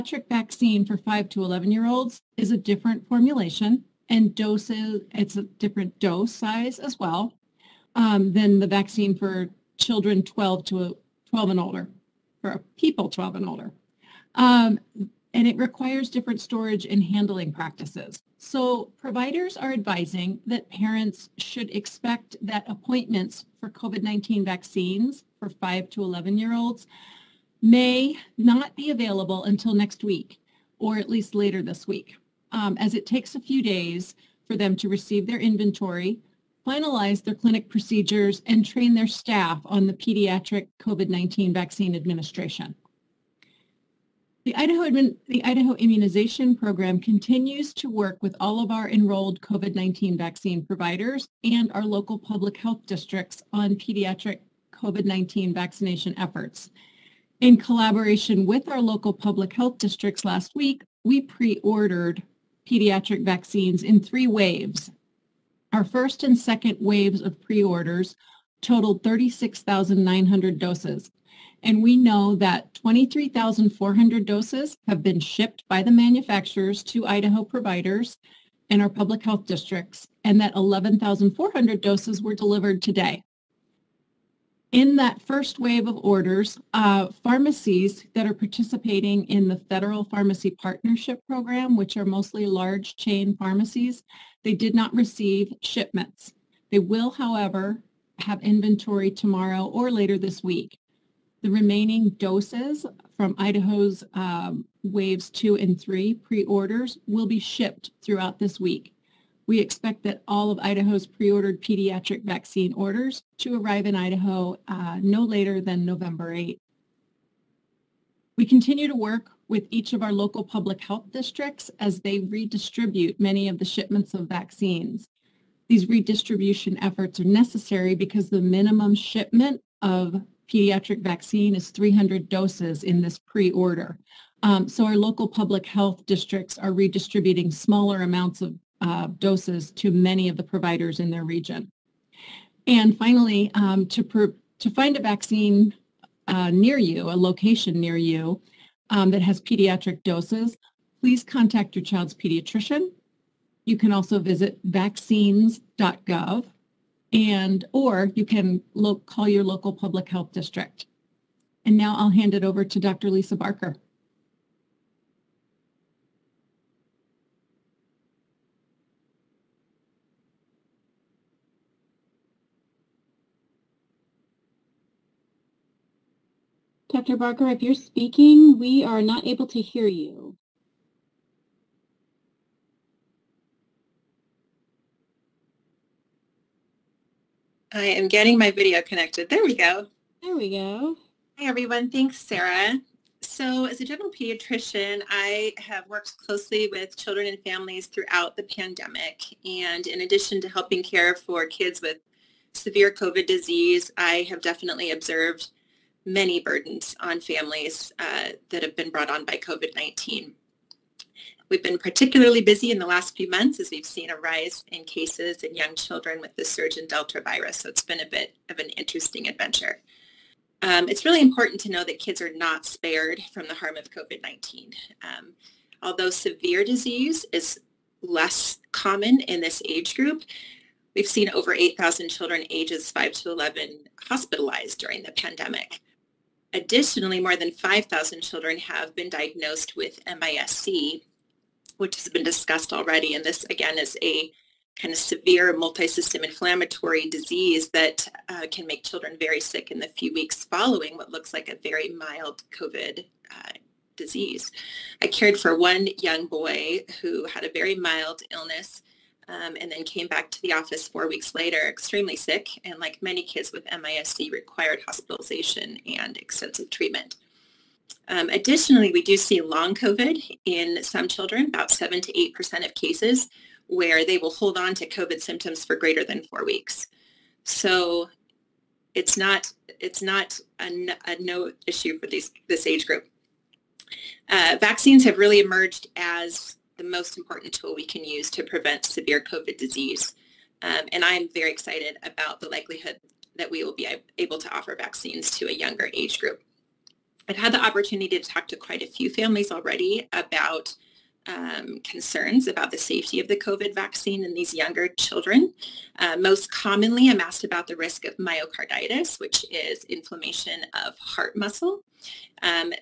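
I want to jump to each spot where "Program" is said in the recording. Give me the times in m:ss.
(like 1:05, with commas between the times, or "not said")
0:46, 1:31.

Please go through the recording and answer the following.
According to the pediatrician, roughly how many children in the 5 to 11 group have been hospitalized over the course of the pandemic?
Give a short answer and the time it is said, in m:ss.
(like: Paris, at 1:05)
8,000, at 3:51.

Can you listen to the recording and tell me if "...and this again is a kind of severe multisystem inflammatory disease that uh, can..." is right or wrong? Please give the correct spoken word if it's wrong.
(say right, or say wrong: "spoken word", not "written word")
right.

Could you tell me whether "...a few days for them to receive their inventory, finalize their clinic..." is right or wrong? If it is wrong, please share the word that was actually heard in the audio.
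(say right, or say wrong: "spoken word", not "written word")
right.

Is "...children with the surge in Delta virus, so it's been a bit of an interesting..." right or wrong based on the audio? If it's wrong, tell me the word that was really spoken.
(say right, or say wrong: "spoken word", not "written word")
right.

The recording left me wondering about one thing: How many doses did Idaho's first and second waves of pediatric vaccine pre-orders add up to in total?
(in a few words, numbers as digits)
36,900.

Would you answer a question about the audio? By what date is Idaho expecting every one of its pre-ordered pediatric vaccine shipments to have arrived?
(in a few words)
November 8.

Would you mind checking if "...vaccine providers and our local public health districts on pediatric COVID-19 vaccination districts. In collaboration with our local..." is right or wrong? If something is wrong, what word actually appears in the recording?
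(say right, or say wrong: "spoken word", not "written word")
wrong: "efforts", not "districts".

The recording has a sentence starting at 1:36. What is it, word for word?
They will, however, have inventory tomorrow or later this week.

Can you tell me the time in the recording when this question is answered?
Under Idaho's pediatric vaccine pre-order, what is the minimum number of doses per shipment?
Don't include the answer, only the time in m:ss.
2:11.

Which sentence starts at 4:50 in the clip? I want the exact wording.
Um, and I'm very excited about the likelihood that we will be able to offer vaccines to a younger age group.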